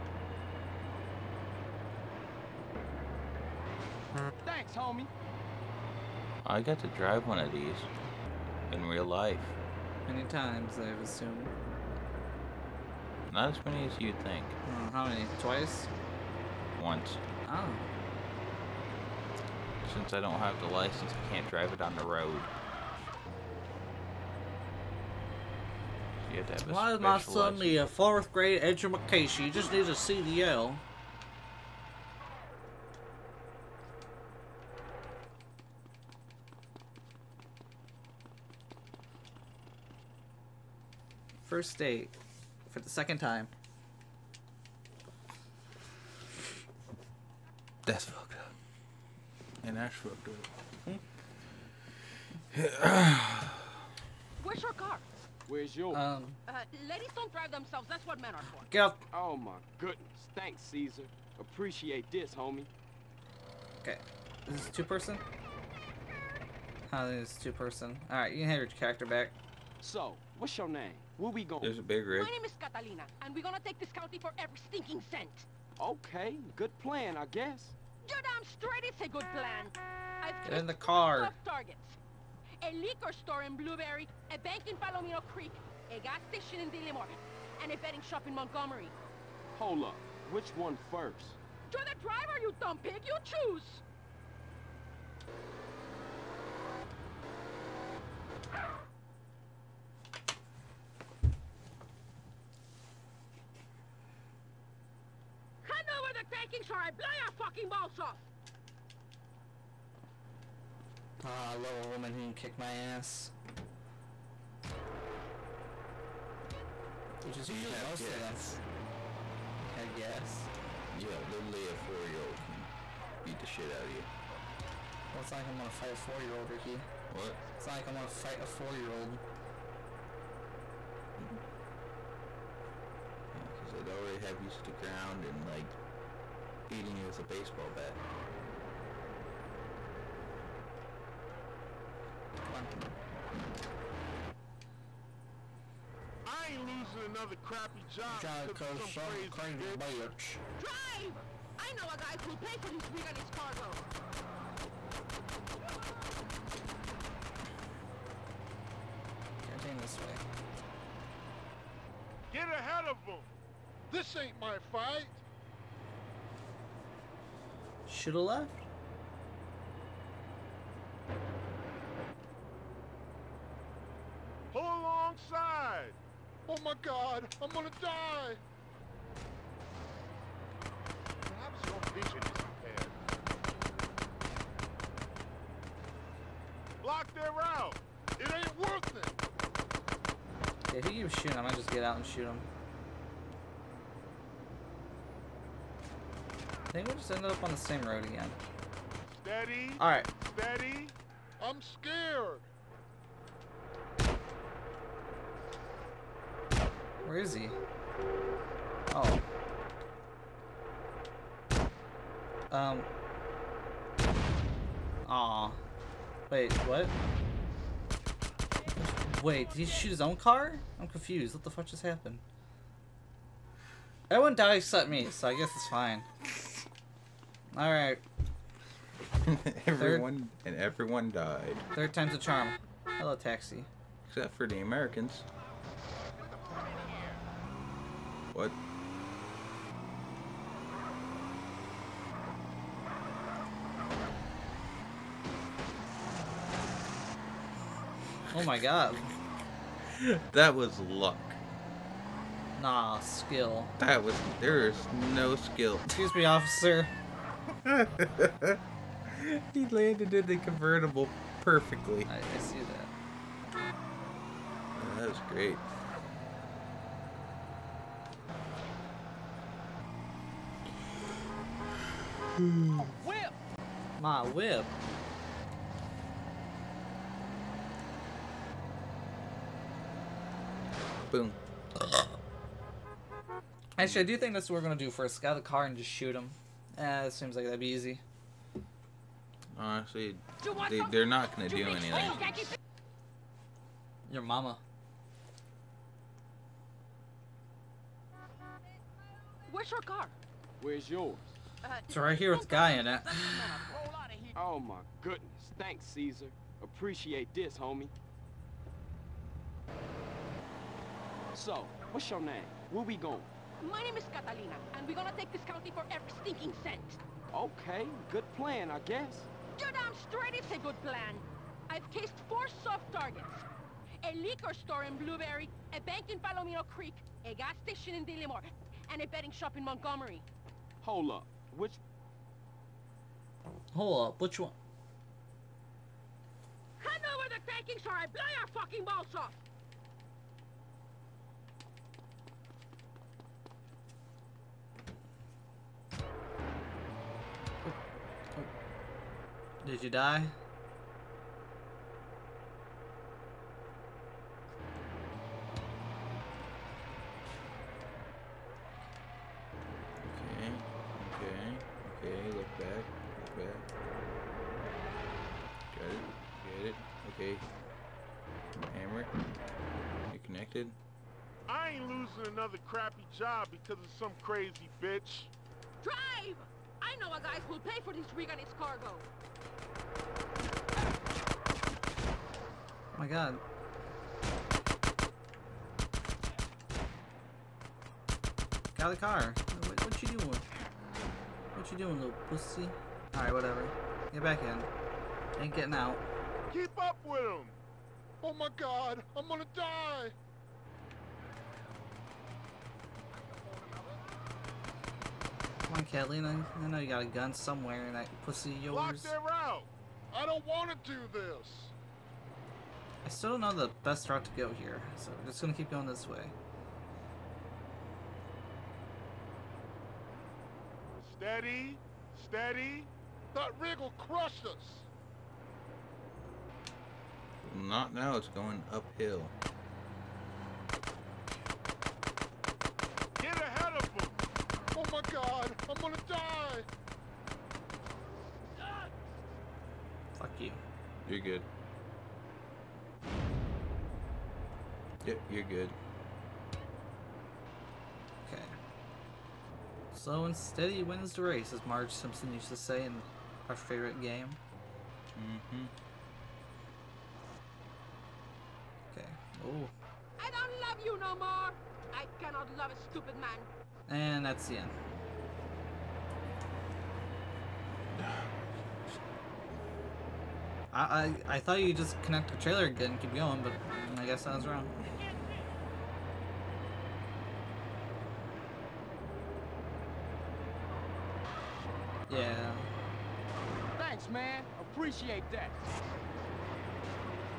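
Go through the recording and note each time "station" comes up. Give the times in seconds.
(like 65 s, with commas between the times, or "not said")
86 s, 327 s.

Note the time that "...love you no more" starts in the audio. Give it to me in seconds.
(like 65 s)
460 s.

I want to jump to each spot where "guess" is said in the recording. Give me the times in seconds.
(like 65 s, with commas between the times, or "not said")
77 s, 225 s, 318 s, 474 s.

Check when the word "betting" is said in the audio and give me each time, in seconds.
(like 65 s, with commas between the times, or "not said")
87 s, 329 s.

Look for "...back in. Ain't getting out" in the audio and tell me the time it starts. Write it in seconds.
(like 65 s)
394 s.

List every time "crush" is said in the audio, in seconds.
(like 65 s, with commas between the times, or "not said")
423 s.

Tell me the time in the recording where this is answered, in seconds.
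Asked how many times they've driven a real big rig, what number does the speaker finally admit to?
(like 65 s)
16 s.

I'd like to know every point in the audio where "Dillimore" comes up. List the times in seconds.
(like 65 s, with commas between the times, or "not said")
86 s, 328 s.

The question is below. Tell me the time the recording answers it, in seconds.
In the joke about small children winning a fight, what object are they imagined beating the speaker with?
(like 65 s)
137 s.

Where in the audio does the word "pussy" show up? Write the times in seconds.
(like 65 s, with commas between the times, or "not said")
392 s, 408 s.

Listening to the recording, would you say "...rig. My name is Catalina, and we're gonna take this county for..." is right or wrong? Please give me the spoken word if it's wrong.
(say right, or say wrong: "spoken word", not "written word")
right.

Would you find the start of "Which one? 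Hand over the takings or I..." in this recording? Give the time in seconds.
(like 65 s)
334 s.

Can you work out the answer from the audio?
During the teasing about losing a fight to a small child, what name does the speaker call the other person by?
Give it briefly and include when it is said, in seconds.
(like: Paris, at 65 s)
Ricky, at 126 s.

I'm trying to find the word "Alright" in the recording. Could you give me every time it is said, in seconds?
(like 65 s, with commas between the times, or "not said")
68 s, 393 s.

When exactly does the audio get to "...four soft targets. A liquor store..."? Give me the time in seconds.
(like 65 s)
322 s.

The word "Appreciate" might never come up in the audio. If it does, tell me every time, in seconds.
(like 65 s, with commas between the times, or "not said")
61 s, 306 s, 484 s.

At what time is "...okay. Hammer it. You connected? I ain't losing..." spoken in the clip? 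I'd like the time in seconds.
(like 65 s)
367 s.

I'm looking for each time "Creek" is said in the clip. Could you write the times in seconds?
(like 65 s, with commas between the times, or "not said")
85 s, 326 s.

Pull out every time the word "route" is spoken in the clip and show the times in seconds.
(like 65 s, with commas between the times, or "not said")
187 s, 409 s, 414 s.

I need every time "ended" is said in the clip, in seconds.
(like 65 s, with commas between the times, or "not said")
197 s.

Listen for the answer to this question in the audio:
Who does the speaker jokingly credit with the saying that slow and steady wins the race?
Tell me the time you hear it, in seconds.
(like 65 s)
451 s.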